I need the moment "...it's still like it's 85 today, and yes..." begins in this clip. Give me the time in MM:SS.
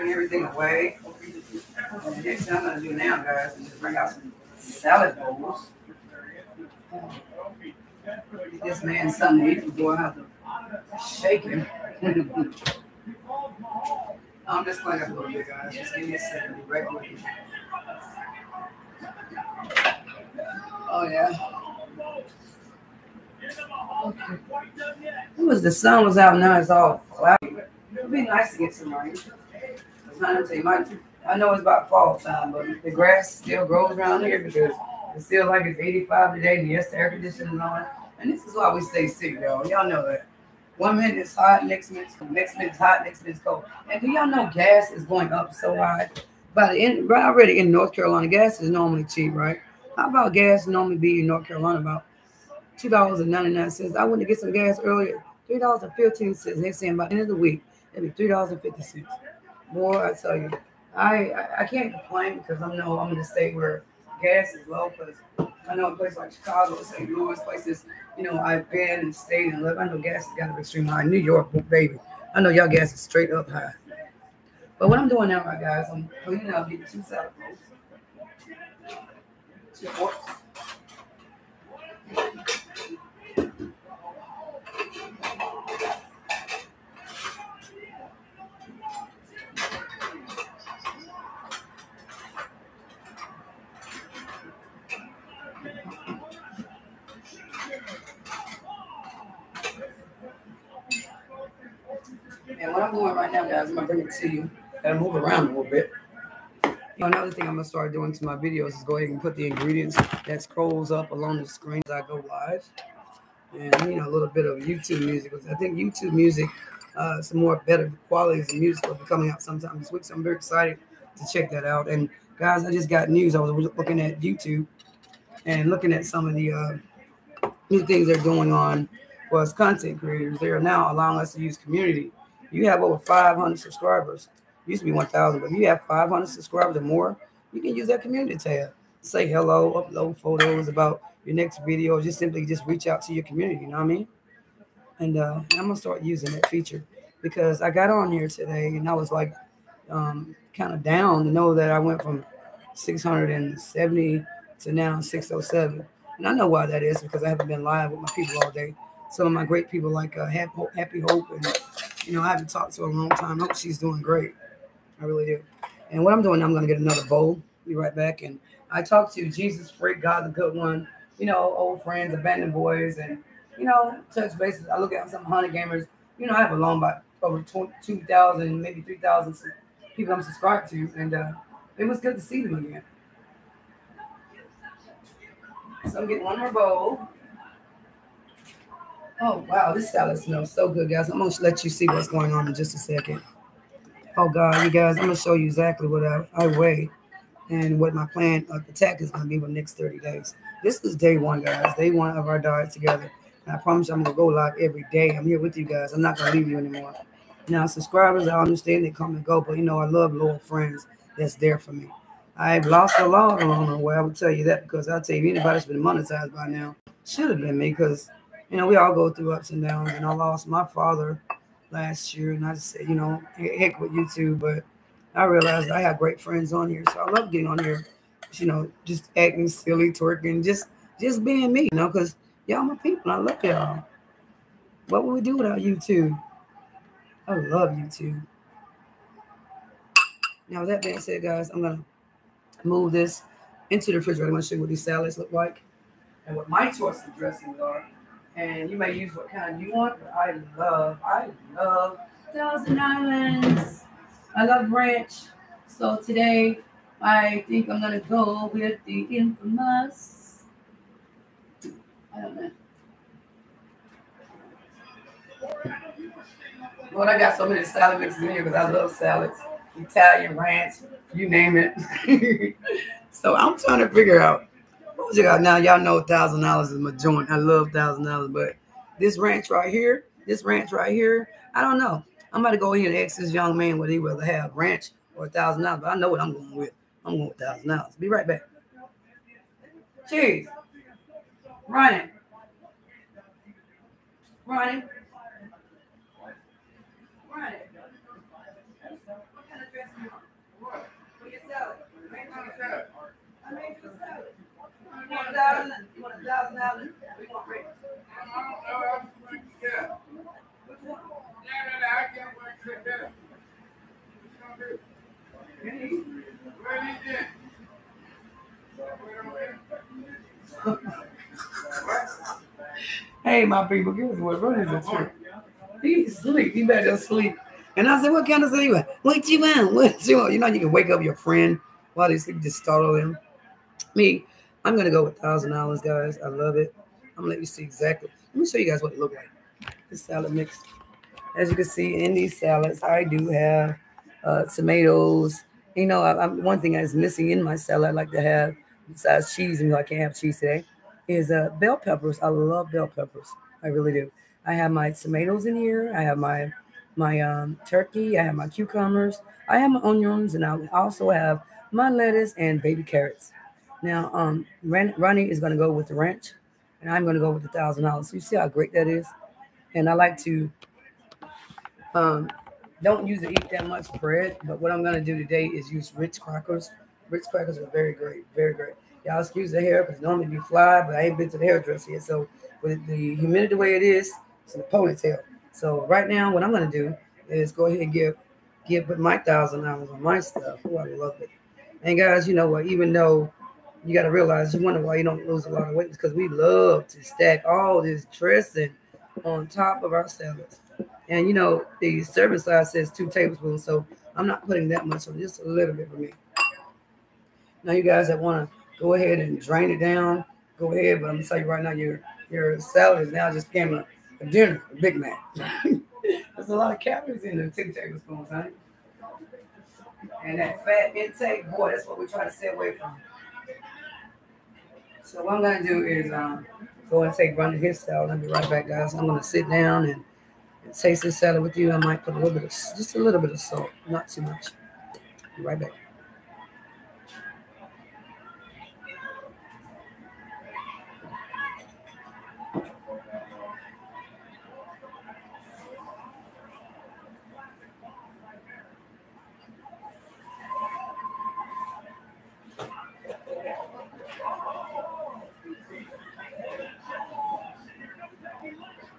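00:35.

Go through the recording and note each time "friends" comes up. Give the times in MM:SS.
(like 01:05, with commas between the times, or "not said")
02:51, 03:30, 03:46, 05:31.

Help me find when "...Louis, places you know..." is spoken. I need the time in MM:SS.
01:07.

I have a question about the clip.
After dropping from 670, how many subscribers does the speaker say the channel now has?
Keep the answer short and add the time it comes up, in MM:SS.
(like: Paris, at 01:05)
607, at 02:35.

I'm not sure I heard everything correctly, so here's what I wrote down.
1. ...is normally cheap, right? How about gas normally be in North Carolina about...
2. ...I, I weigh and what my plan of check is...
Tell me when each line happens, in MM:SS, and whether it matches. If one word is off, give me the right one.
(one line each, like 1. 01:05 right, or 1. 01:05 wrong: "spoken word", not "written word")
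1. 00:48 right
2. 03:16 wrong: "attack", not "check".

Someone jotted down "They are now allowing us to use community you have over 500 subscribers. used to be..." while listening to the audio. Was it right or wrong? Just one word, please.
right.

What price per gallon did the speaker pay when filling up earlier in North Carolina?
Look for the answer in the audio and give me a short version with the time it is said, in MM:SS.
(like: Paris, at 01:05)
$3.15, at 00:55.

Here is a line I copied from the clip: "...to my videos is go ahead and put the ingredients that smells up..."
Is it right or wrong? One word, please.
wrong.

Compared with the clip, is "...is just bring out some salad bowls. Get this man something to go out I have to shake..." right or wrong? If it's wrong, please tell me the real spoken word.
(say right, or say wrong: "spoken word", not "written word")
right.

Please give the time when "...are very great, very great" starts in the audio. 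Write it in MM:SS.
06:17.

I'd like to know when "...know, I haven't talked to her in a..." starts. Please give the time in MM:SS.
02:42.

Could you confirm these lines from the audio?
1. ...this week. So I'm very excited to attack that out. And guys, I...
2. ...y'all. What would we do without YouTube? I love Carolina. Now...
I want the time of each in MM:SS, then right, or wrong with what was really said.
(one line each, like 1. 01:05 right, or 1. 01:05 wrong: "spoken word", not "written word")
1. 01:59 wrong: "check", not "attack"
2. 03:53 wrong: "YouTube", not "Carolina".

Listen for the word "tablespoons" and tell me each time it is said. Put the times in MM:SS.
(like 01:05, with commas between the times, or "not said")
06:43, 06:57.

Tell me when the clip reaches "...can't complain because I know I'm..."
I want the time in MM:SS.
01:01.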